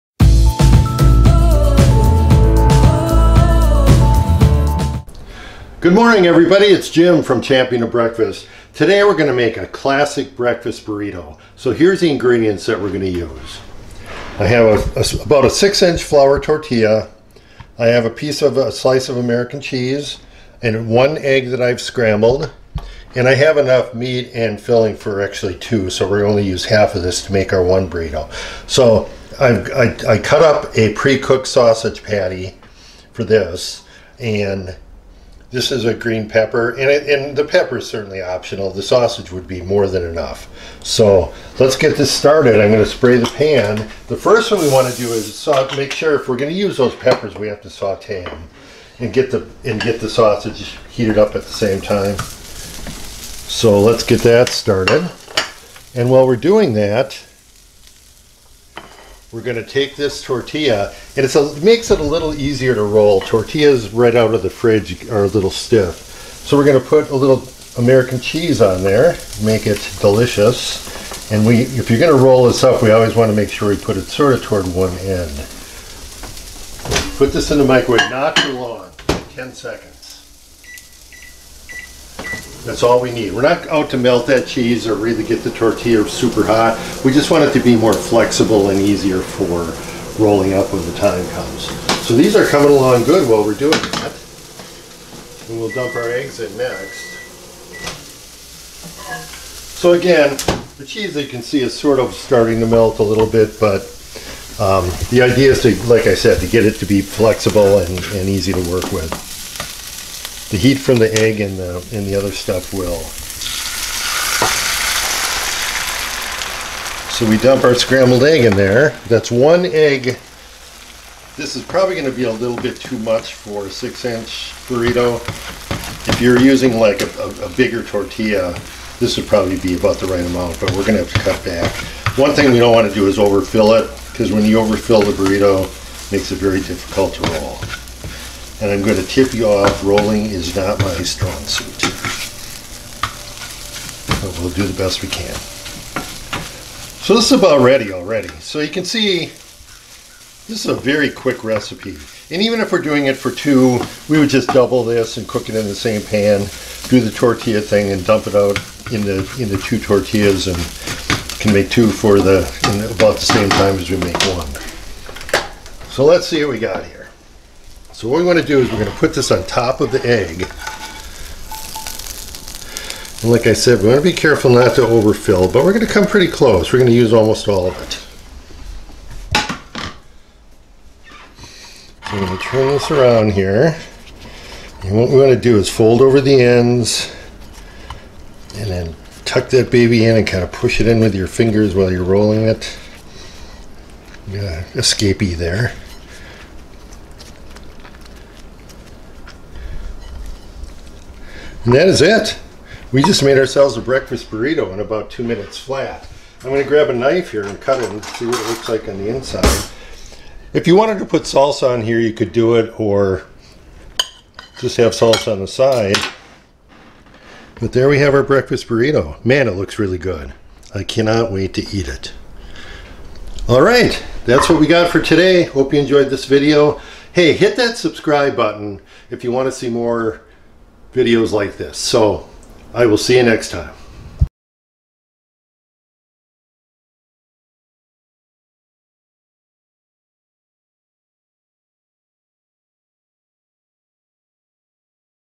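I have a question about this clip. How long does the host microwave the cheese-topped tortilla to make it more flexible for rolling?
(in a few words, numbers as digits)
10 seconds.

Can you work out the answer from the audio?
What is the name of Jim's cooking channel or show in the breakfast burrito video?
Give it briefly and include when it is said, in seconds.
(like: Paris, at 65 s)
Champion of Breakfast, at 7 s.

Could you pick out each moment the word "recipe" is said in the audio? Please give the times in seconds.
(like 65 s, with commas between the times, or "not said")
151 s.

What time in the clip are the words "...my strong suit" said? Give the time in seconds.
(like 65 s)
140 s.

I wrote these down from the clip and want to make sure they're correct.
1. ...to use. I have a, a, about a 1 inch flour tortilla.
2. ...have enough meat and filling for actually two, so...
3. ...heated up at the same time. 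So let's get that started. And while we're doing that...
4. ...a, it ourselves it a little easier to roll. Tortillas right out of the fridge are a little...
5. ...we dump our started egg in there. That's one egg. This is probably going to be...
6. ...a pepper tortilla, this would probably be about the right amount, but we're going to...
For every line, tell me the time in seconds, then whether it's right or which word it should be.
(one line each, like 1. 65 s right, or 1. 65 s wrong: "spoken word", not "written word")
1. 13 s wrong: "6", not "1"
2. 23 s right
3. 50 s right
4. 61 s wrong: "makes", not "ourselves"
5. 117 s wrong: "scrambled", not "started"
6. 127 s wrong: "bigger", not "pepper".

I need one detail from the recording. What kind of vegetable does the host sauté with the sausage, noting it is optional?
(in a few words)
green pepper.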